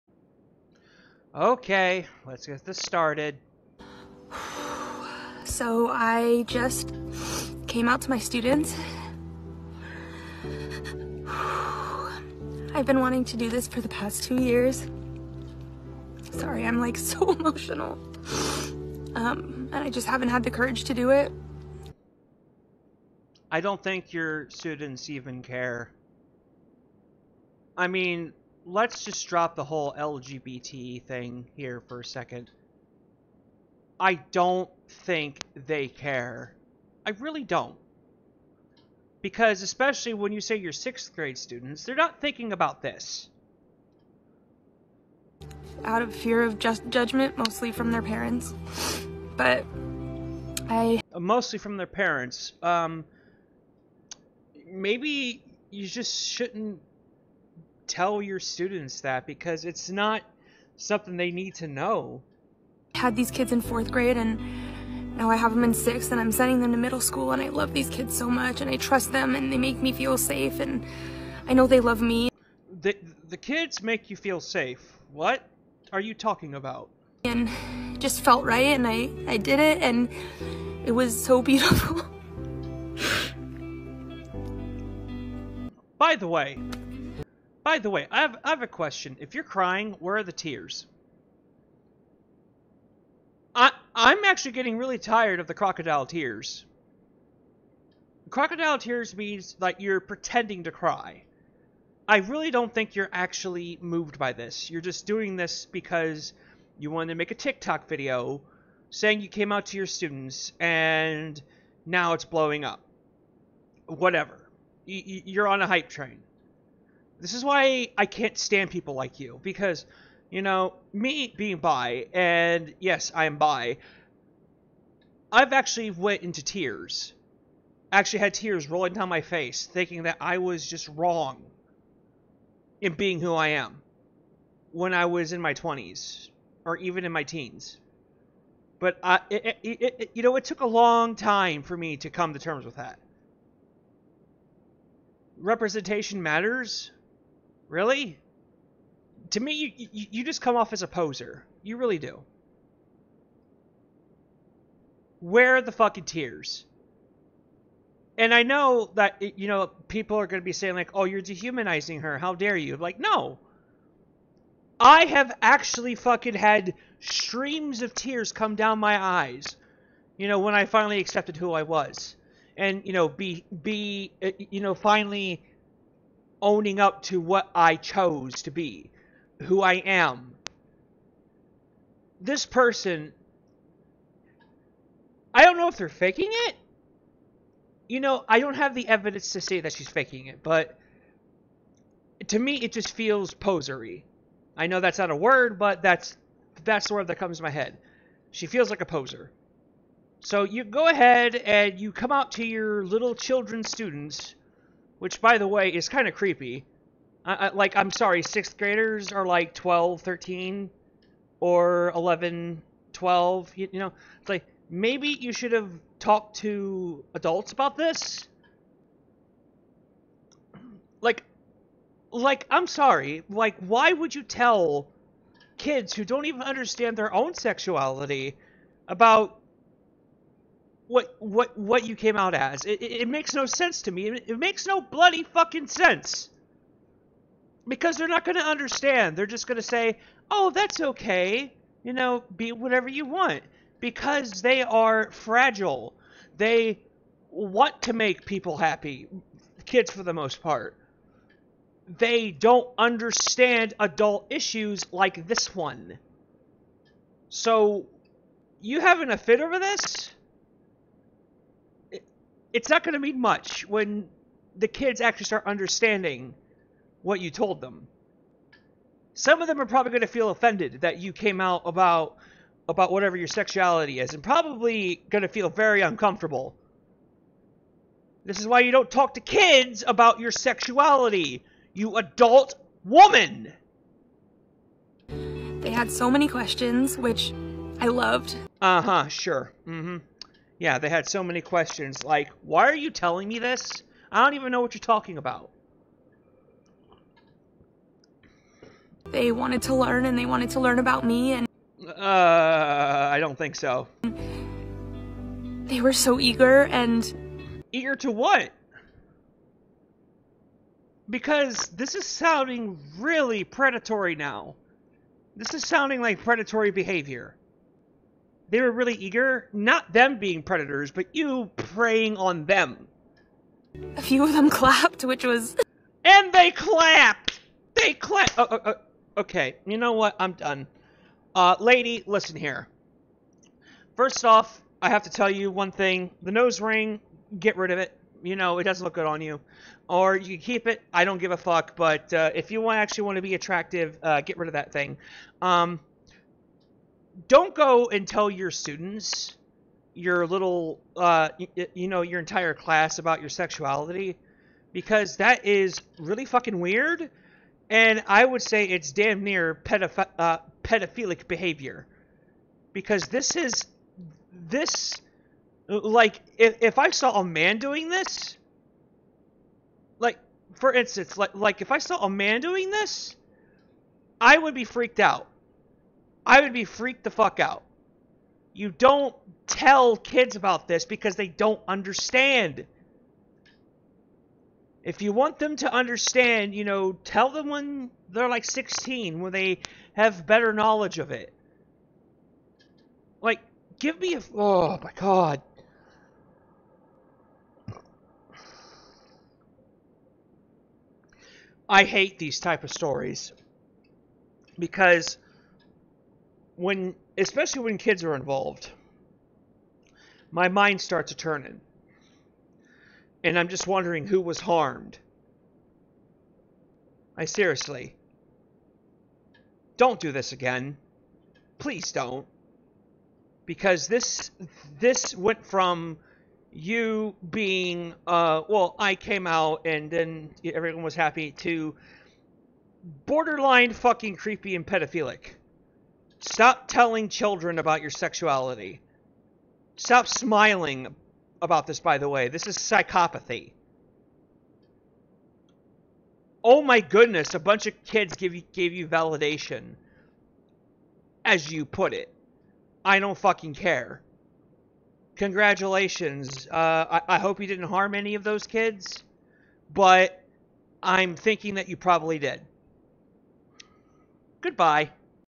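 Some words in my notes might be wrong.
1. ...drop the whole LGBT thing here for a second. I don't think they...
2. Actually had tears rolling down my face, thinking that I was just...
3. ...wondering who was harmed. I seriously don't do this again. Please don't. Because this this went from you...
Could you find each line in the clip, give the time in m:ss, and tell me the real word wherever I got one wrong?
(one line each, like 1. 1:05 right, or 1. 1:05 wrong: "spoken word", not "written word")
1. 0:29 right
2. 2:07 right
3. 6:53 right.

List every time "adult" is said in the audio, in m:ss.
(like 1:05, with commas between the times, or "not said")
3:37, 4:13, 4:41.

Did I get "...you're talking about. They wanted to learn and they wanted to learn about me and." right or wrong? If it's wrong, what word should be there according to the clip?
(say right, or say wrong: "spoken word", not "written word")
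right.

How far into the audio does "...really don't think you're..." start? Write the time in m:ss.
1:42.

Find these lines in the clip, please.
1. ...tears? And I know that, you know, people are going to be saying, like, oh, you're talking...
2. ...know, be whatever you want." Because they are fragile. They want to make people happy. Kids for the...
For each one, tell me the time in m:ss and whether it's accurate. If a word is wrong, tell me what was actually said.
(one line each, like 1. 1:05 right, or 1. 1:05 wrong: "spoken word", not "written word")
1. 2:36 wrong: "dehumanizing", not "talking"
2. 4:01 right.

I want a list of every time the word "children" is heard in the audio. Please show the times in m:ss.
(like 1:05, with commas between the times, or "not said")
3:23, 7:17.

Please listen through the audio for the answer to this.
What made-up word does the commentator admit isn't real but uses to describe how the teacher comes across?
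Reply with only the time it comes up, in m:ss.
3:13.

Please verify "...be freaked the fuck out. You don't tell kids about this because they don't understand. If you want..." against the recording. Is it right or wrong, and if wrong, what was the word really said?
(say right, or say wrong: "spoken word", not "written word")
right.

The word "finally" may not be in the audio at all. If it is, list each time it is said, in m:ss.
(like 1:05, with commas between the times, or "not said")
2:50, 2:54.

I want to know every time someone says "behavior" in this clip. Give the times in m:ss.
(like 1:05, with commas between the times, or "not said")
5:16, 6:01.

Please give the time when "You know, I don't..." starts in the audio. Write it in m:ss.
3:07.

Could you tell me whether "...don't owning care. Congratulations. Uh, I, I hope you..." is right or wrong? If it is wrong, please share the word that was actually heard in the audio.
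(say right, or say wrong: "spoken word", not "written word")
wrong: "fucking", not "owning".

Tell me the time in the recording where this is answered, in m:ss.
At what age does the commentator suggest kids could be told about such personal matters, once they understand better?
6:28.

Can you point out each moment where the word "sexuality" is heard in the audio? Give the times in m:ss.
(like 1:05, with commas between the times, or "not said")
3:47, 4:33, 4:40, 5:53, 7:17.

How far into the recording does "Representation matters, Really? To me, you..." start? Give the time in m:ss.
2:25.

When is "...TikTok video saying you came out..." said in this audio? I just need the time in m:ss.
1:47.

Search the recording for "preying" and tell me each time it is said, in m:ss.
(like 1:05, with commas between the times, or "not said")
5:21.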